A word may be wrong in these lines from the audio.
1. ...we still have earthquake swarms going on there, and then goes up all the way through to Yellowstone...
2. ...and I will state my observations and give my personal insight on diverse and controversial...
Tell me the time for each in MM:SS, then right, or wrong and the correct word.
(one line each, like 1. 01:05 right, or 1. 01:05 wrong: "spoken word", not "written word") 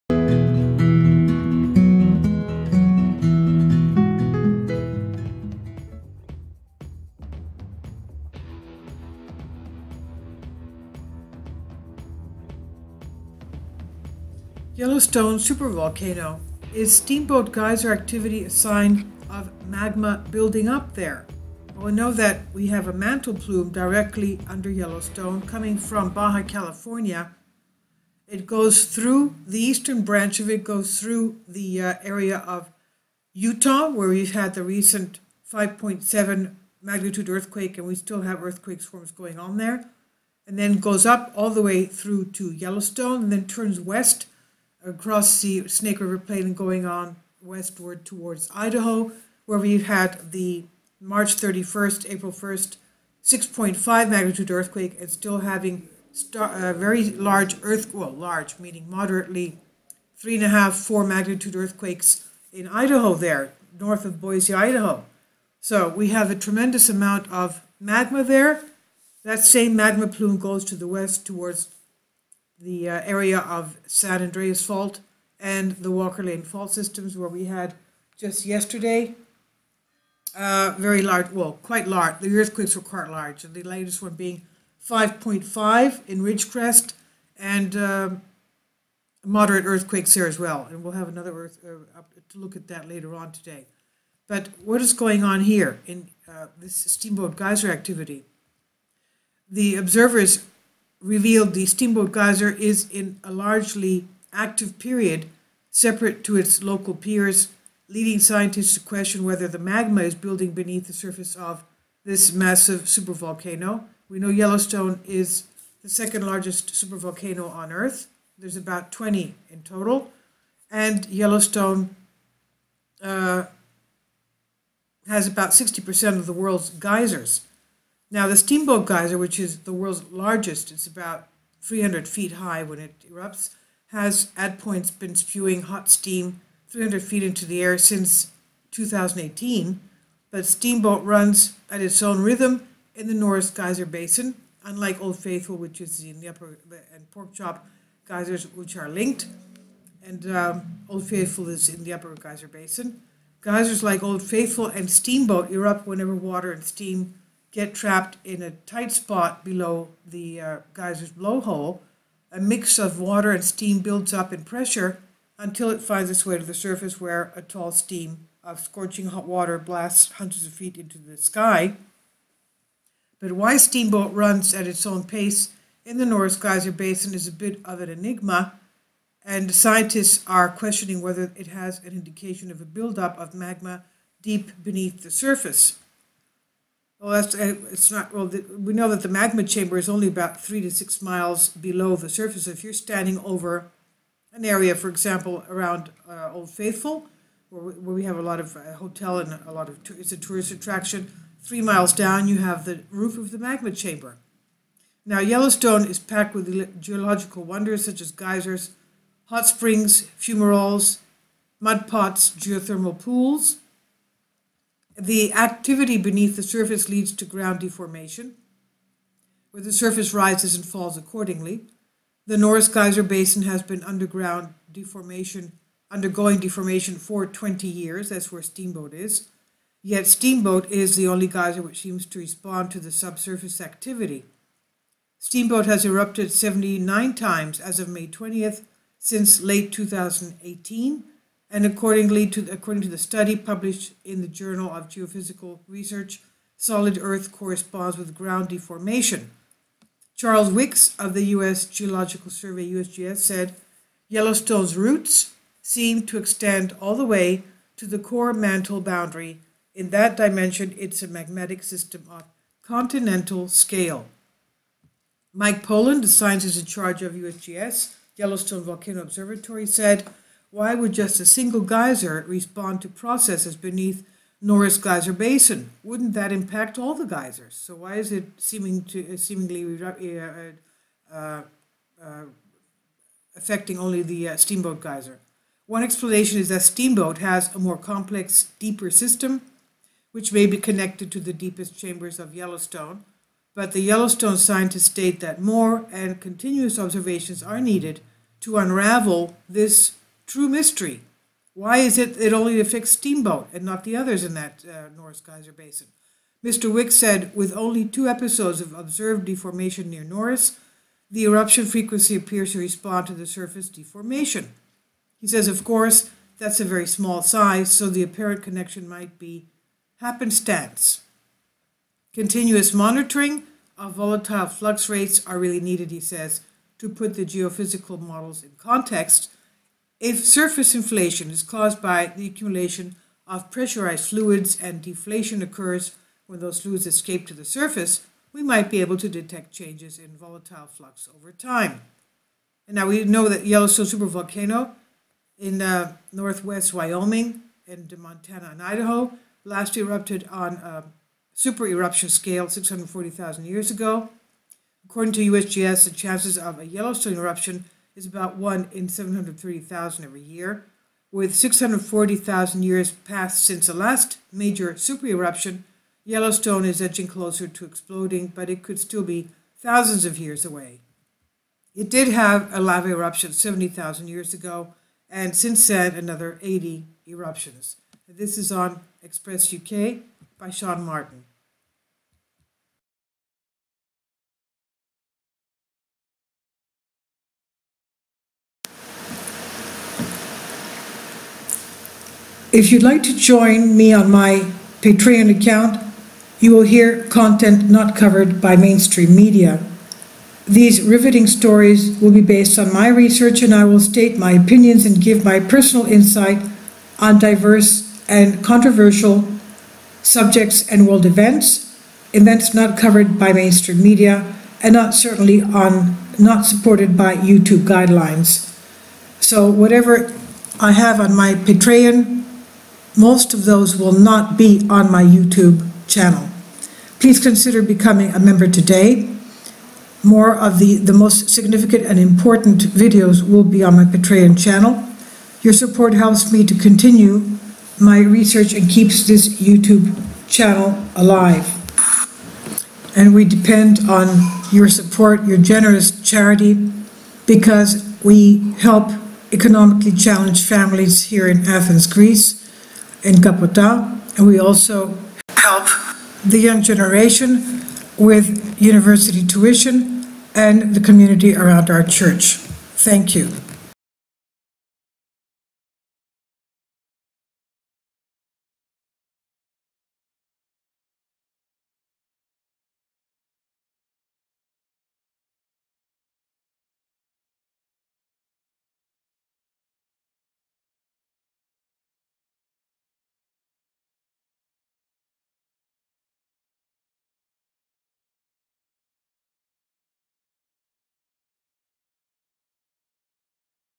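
1. 00:37 right
2. 06:43 wrong: "opinions", not "observations".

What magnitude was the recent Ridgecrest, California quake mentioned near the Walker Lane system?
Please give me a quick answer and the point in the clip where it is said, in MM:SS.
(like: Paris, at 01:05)
5.5, at 01:24.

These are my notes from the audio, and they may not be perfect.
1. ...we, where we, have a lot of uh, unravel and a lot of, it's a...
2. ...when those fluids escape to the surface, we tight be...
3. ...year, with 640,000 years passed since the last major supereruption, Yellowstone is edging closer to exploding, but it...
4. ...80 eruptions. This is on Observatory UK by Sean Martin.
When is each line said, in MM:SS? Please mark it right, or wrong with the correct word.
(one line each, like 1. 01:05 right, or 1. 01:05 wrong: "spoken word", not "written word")
1. 03:17 wrong: "hotel", not "unravel"
2. 05:36 wrong: "might", not "tight"
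3. 06:00 right
4. 06:16 wrong: "Express", not "Observatory".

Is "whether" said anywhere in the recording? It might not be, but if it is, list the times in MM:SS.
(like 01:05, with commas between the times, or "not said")
01:49, 03:01.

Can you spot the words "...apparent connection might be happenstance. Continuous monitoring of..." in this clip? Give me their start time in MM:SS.
05:18.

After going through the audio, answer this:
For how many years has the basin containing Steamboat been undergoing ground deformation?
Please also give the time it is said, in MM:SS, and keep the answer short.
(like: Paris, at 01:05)
20 years, at 03:47.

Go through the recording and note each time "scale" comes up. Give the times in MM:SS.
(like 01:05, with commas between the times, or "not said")
04:23, 05:52.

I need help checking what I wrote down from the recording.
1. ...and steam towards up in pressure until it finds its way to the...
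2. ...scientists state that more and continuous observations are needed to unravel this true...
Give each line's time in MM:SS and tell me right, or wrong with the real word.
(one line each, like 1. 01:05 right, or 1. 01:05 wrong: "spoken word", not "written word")
1. 02:43 wrong: "builds", not "towards"
2. 04:54 right.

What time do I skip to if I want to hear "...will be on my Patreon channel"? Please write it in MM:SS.
07:13.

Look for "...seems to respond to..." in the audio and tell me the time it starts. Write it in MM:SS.
03:51.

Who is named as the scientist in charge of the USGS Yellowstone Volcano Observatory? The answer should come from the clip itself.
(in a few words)
Mike Poland.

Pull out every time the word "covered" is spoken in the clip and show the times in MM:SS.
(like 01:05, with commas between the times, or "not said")
06:37, 06:52.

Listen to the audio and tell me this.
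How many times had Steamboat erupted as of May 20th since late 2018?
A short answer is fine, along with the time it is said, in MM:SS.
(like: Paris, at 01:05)
79, at 03:56.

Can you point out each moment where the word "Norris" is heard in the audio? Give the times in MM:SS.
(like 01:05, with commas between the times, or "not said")
02:23, 02:56, 03:42, 04:34, 05:04, 05:10.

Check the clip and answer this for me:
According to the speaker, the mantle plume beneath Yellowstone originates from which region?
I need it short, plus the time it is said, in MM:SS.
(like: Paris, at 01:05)
Baja California, at 00:26.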